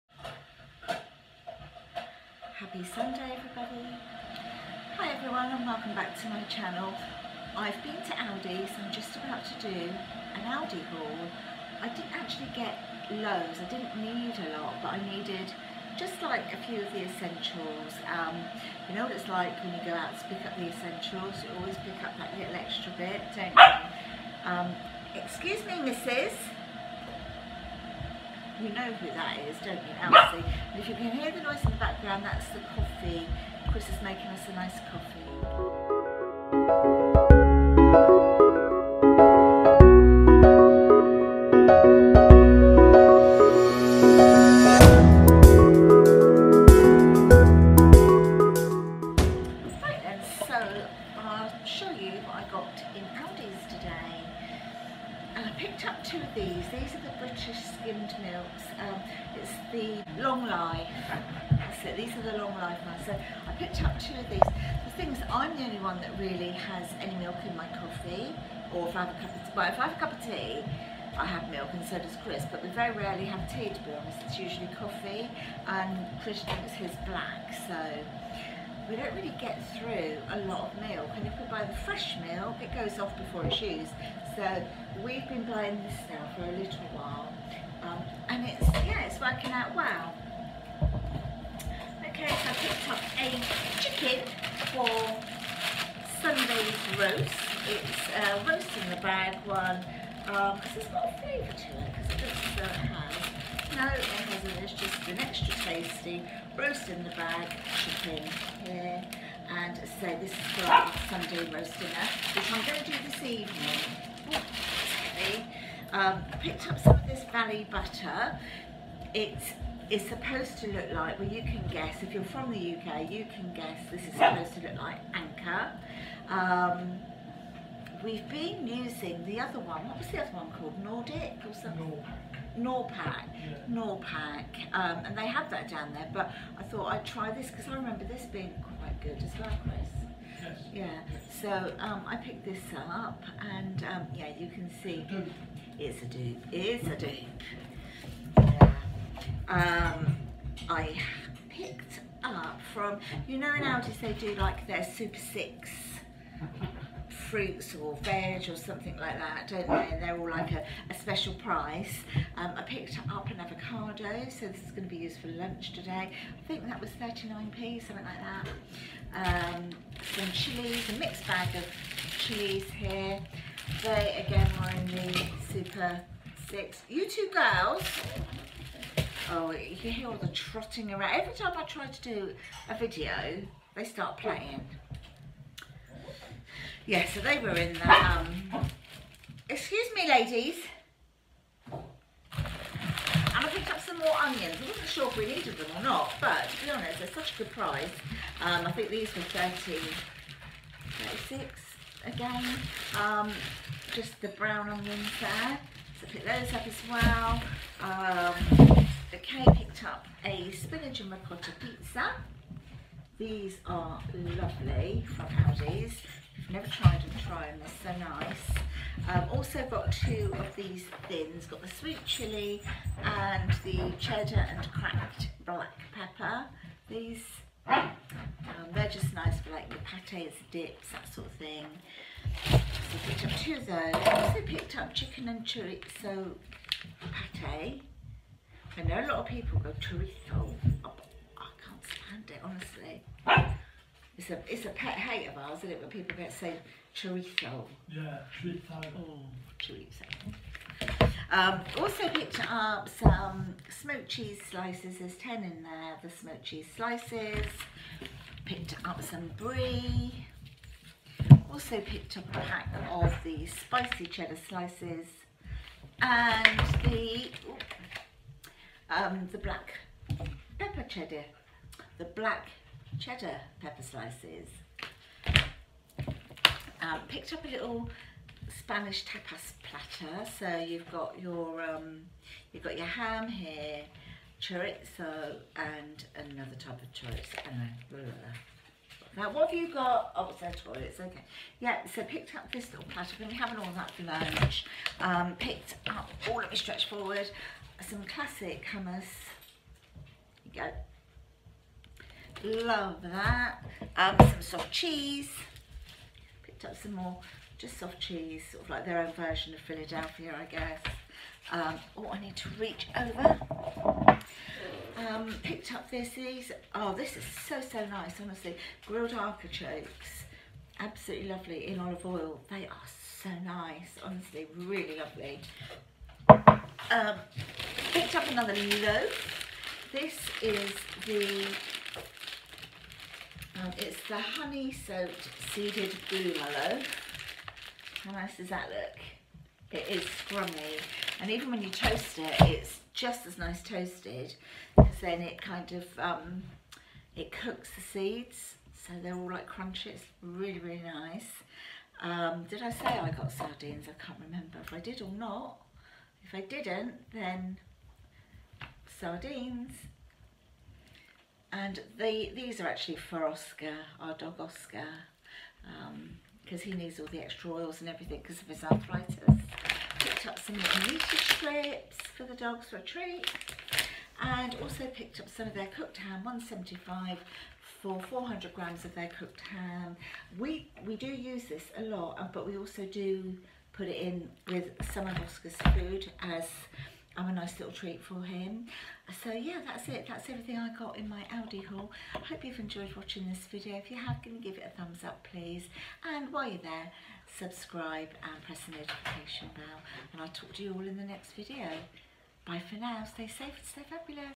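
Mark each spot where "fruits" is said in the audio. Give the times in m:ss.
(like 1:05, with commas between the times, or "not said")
2:37.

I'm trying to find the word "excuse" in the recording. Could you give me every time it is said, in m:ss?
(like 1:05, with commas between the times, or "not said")
0:25, 3:09.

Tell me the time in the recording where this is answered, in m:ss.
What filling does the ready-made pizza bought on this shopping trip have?
3:30.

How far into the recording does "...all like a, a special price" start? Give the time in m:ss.
2:40.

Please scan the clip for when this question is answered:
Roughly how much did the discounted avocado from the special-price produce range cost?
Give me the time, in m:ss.
2:47.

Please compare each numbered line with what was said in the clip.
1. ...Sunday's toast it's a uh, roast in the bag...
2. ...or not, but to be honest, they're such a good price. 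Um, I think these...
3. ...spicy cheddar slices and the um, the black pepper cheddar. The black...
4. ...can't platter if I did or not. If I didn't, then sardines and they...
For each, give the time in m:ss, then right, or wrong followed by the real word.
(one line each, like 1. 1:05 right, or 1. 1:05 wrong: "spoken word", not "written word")
1. 1:36 wrong: "roast", not "toast"
2. 3:15 right
3. 4:23 right
4. 5:54 wrong: "remember", not "platter".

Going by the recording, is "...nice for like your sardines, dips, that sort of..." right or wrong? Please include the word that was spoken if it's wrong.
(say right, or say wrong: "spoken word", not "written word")
wrong: "pates", not "sardines".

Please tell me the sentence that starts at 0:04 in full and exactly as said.
Hi everyone and welcome back to my channel.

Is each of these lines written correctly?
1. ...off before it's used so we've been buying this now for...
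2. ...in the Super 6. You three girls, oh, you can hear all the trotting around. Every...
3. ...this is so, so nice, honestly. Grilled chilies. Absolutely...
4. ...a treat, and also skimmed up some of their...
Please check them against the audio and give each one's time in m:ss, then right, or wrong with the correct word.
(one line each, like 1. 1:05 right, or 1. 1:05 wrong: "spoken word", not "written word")
1. 1:22 right
2. 2:54 wrong: "two", not "three"
3. 5:16 wrong: "artichokes", not "chilies"
4. 6:12 wrong: "picked", not "skimmed".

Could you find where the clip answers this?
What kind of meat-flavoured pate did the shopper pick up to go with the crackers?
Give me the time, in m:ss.
3:54.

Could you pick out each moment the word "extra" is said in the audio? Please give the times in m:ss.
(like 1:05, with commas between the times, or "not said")
0:22, 1:45, 6:07.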